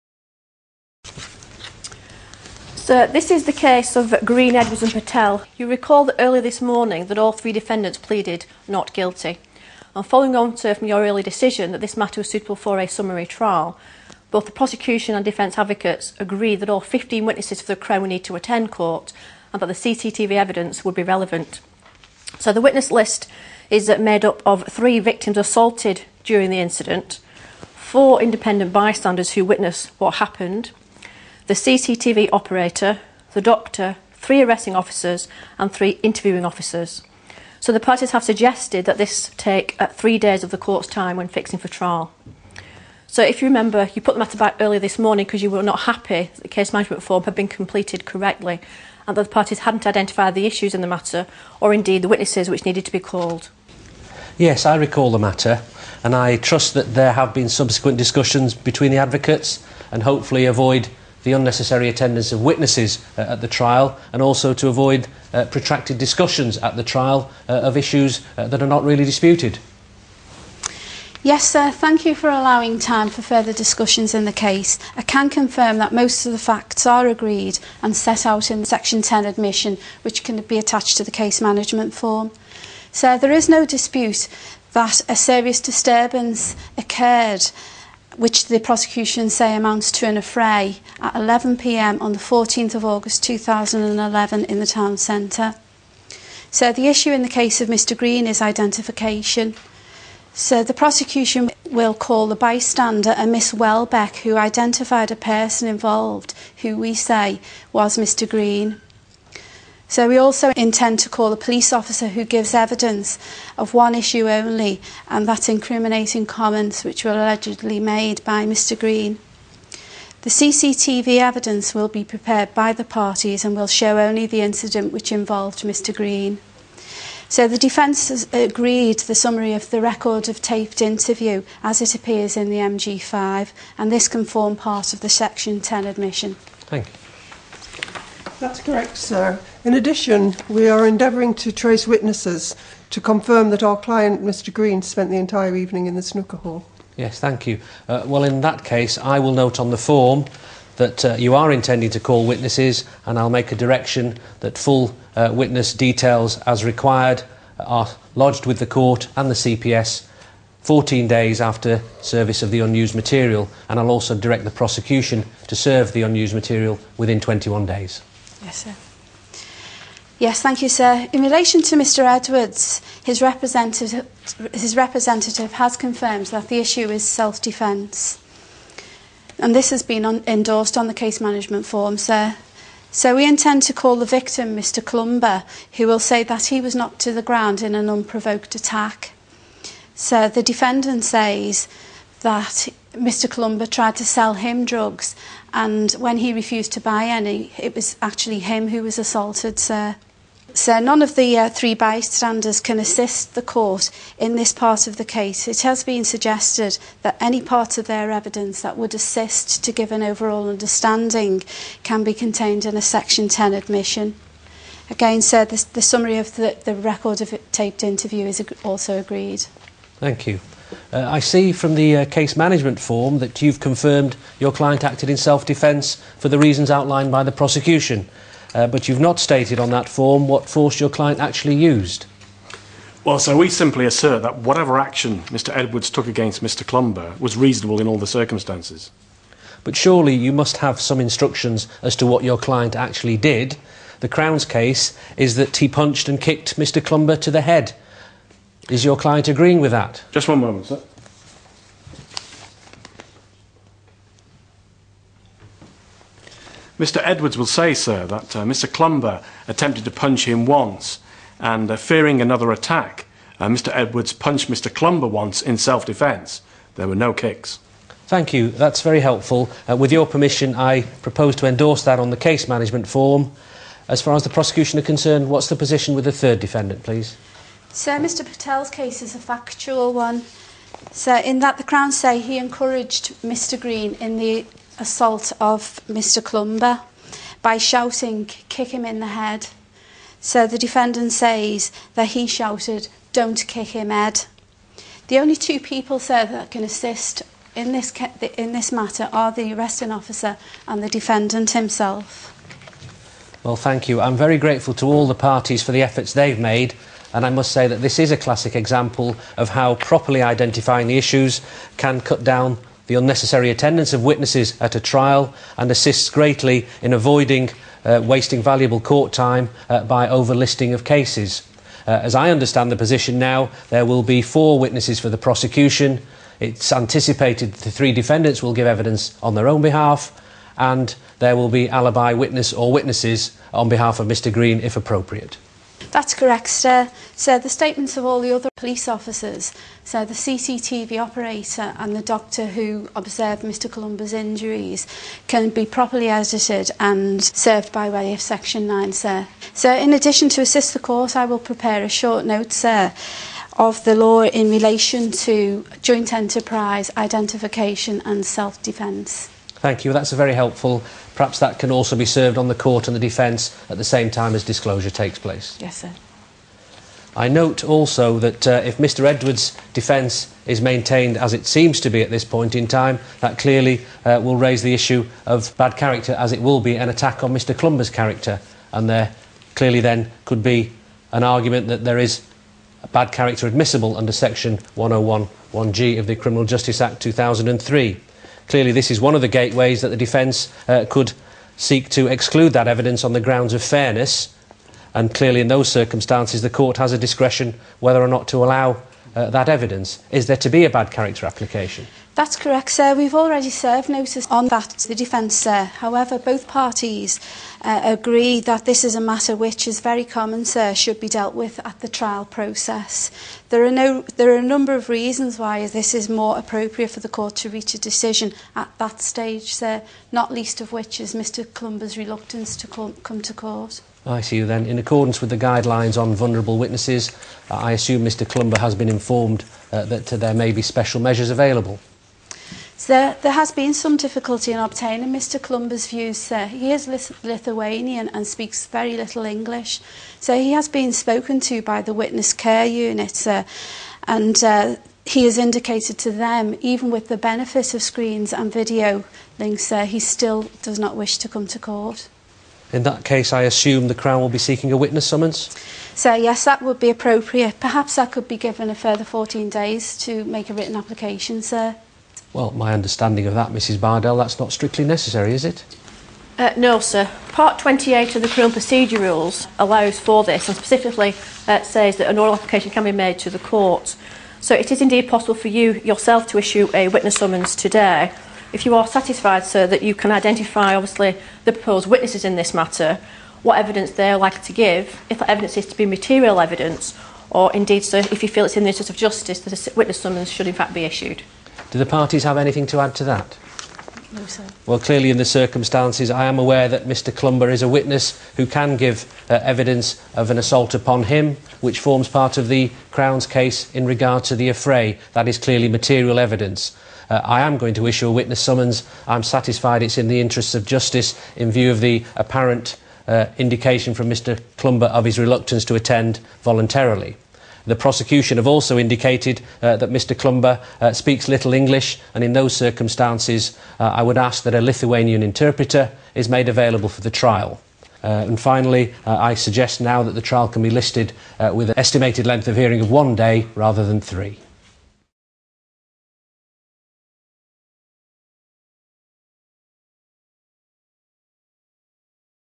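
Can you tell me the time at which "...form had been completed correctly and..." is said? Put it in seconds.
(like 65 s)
47 s.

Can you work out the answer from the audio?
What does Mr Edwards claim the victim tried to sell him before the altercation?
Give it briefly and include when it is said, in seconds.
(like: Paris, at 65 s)
drugs, at 194 s.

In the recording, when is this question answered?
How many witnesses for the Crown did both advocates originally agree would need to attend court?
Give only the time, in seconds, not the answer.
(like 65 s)
16 s.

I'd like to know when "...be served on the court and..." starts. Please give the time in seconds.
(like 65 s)
361 s.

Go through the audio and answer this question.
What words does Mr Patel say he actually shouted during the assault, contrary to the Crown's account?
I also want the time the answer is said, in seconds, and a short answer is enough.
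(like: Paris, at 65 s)
don't kick him head, at 293 s.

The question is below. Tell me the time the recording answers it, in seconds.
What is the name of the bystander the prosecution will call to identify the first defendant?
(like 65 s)
103 s.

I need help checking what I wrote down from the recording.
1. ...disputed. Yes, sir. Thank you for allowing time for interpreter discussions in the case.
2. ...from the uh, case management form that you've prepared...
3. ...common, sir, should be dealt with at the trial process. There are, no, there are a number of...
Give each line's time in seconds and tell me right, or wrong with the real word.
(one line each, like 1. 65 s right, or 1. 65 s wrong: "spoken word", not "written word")
1. 69 s wrong: "further", not "interpreter"
2. 221 s wrong: "confirmed", not "prepared"
3. 410 s right.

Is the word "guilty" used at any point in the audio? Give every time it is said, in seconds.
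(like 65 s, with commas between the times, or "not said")
8 s.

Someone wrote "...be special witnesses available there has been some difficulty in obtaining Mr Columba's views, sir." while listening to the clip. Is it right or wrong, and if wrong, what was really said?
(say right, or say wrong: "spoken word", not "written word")
wrong: "measures", not "witnesses".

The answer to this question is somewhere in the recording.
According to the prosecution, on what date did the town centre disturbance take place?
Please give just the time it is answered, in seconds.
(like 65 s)
92 s.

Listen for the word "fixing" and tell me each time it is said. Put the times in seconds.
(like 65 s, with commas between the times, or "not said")
41 s.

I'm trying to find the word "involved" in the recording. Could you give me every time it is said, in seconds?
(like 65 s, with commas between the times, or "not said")
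105 s, 125 s.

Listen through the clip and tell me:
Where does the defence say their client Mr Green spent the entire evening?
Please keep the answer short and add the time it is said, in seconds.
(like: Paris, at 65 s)
the snooker hall, at 145 s.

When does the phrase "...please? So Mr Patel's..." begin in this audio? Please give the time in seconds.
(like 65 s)
276 s.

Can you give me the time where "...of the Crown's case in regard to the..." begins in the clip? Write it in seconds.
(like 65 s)
502 s.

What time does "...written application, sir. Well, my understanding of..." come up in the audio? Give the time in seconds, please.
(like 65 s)
460 s.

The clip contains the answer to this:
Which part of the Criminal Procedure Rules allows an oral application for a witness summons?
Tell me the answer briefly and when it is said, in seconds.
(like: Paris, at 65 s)
Part 28, at 467 s.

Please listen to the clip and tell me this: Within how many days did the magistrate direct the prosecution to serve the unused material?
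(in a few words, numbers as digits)
21 days.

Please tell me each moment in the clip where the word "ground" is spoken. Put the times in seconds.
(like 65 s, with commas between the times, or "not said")
187 s, 393 s.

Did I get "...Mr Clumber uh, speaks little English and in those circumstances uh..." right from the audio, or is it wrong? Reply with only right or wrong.
right.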